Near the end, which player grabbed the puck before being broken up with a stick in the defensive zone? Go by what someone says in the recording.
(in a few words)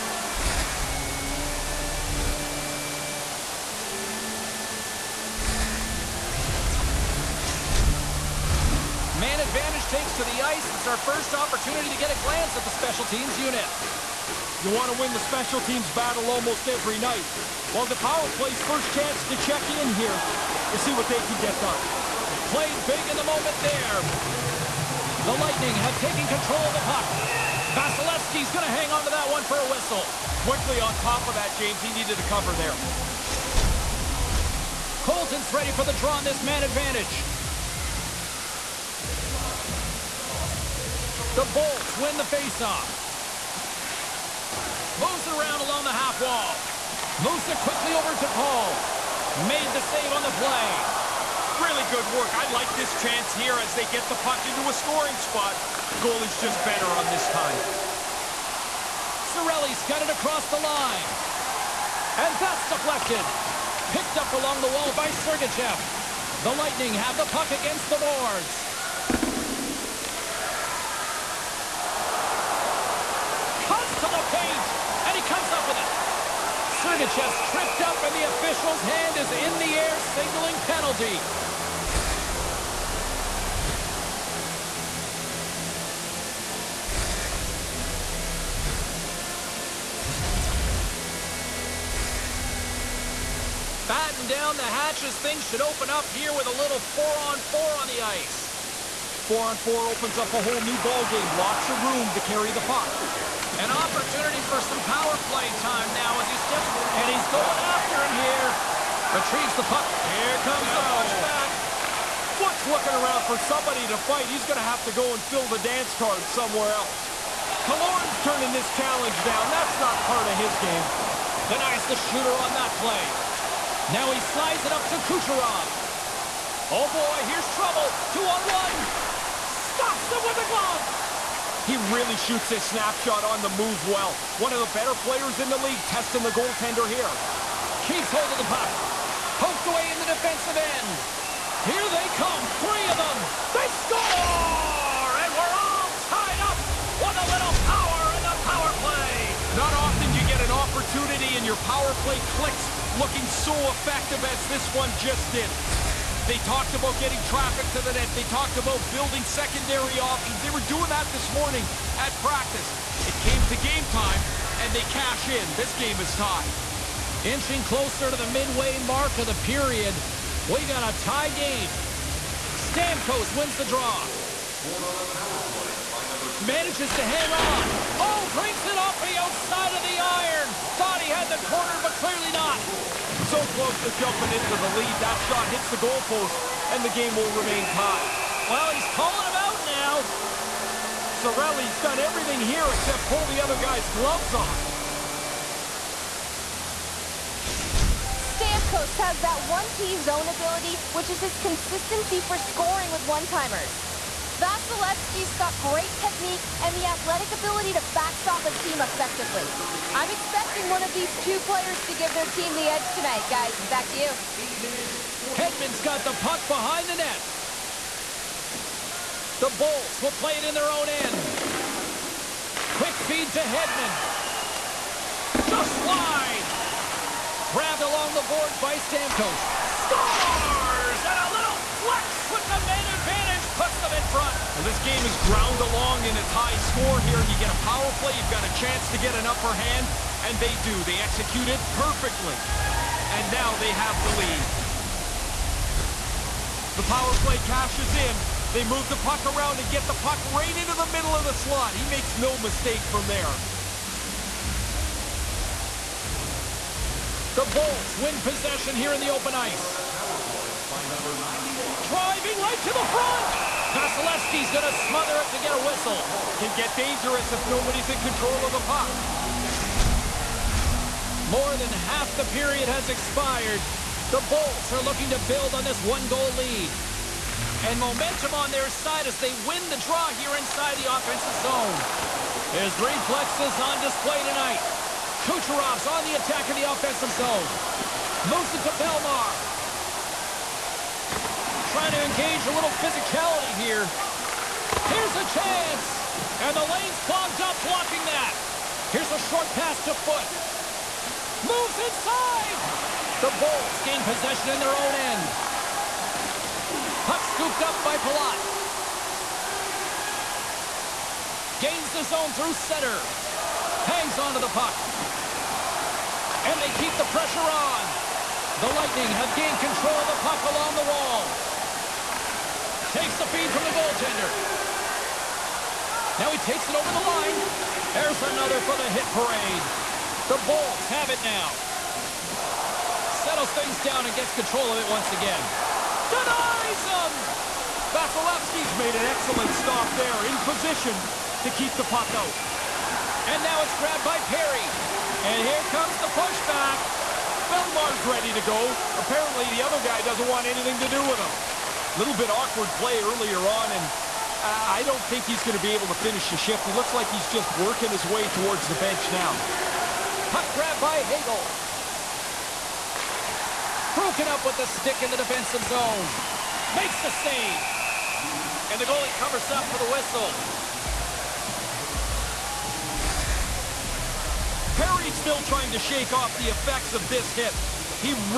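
Hagel.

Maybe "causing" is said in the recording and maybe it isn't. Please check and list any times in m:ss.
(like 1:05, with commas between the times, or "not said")
not said.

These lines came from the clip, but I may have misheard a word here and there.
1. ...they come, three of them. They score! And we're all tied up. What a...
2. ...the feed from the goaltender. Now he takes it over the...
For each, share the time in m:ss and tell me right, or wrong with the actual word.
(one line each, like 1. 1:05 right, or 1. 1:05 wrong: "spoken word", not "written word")
1. 2:21 right
2. 5:23 right.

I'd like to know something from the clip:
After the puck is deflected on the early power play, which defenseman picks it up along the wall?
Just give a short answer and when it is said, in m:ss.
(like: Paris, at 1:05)
Sergachev, at 1:05.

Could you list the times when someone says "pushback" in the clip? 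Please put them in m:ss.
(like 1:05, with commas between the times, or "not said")
1:50, 5:46.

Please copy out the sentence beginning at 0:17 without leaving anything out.
Well, the power play's first chance to check in here to see what they can get done.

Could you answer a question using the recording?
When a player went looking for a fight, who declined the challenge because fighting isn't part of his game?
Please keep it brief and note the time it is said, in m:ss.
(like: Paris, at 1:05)
Killorn, at 1:57.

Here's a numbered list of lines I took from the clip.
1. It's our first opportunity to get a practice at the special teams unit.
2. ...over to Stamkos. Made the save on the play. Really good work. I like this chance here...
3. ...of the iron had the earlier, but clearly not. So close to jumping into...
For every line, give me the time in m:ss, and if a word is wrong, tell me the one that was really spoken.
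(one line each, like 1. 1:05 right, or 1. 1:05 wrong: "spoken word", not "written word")
1. 0:10 wrong: "glance", not "practice"
2. 0:47 wrong: "Paul", not "Stamkos"
3. 2:59 wrong: "corner", not "earlier".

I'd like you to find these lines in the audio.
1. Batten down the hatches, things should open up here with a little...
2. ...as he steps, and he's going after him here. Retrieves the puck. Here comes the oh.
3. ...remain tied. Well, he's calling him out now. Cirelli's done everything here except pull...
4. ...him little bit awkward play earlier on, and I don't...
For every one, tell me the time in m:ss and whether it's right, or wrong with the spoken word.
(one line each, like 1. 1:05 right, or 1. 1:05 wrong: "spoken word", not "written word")
1. 1:33 right
2. 1:46 right
3. 3:07 right
4. 5:51 right.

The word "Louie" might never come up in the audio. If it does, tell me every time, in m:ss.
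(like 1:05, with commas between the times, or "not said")
not said.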